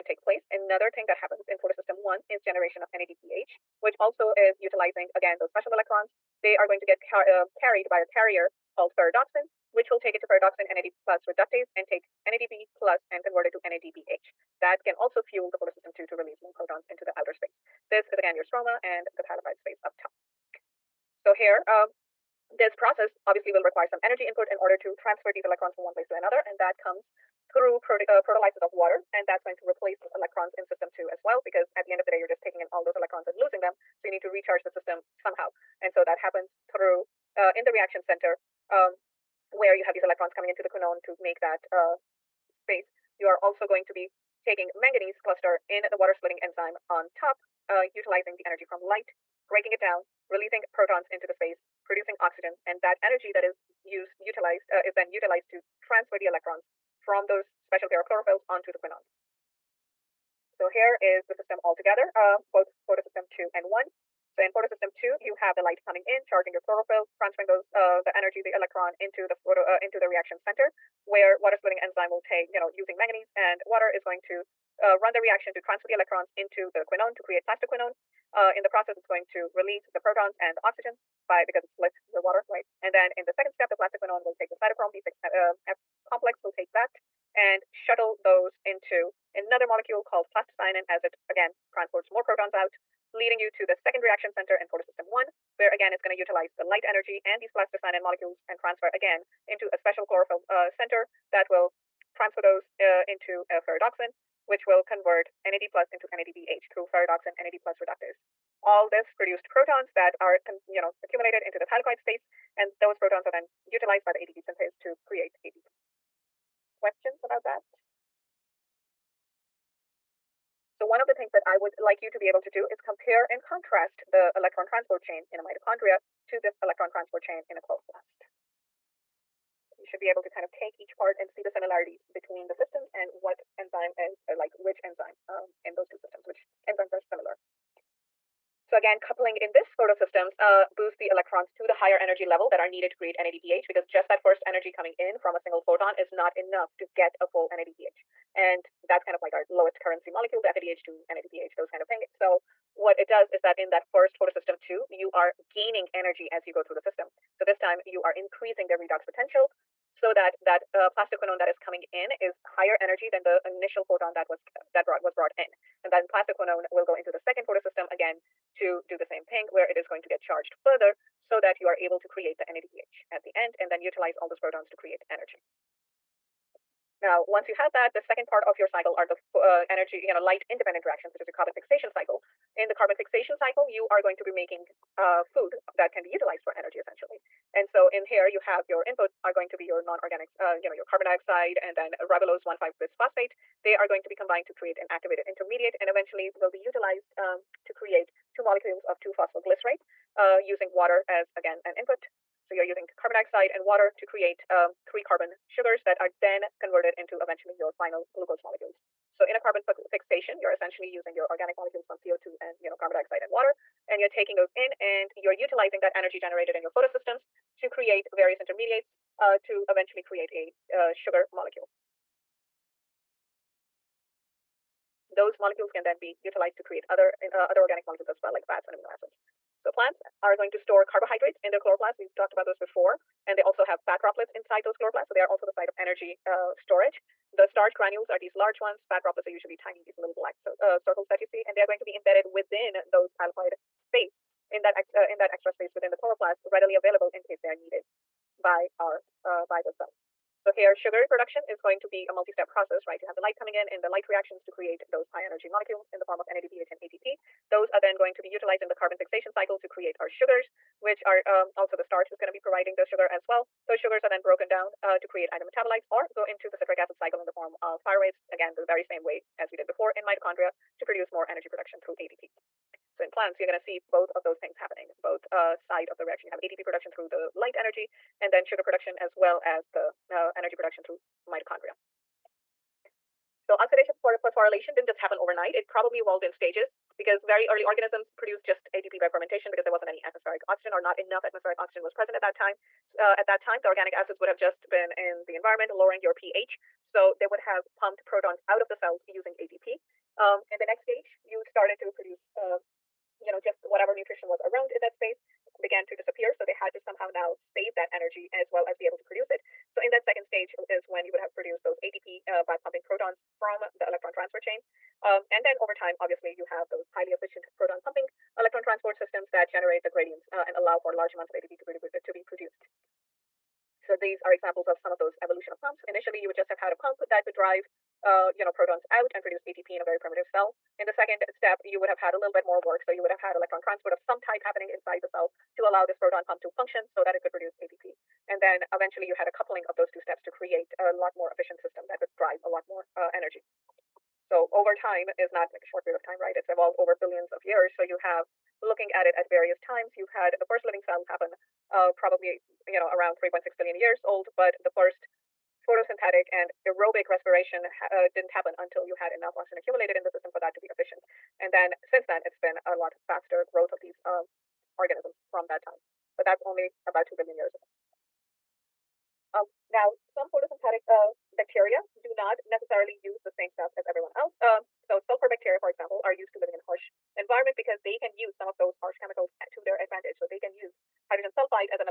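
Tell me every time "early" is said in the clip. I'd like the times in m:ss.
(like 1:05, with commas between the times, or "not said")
4:47.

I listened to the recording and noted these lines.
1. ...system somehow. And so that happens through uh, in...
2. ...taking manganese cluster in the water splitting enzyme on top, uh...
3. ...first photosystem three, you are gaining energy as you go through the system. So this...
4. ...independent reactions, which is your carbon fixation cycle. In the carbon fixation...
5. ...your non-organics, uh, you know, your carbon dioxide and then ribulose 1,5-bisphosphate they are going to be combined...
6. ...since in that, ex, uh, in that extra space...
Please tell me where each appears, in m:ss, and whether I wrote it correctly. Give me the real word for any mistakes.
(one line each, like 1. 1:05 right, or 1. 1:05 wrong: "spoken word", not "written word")
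1. 0:34 right
2. 0:44 right
3. 2:33 wrong: "two", not "three"
4. 3:00 right
5. 3:09 right
6. 4:03 wrong: "space", not "since".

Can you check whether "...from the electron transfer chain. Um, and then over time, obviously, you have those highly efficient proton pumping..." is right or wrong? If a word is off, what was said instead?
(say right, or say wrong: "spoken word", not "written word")
right.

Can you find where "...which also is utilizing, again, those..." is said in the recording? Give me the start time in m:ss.
0:03.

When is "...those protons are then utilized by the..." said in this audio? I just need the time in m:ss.
1:52.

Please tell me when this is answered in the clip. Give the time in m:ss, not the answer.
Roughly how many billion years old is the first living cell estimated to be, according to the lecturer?
5:53.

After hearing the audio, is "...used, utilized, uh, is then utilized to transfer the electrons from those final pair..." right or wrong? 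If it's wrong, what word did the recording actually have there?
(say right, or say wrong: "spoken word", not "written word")
wrong: "special", not "final".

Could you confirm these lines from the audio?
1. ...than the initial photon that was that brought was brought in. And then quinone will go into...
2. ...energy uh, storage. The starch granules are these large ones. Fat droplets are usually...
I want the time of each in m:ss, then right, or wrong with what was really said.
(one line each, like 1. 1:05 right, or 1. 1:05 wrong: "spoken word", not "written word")
1. 2:43 wrong: "plastoquinone", not "quinone"
2. 3:55 right.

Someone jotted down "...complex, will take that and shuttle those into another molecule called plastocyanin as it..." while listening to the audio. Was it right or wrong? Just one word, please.
right.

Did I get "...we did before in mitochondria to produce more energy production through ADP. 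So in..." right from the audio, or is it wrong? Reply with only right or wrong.
right.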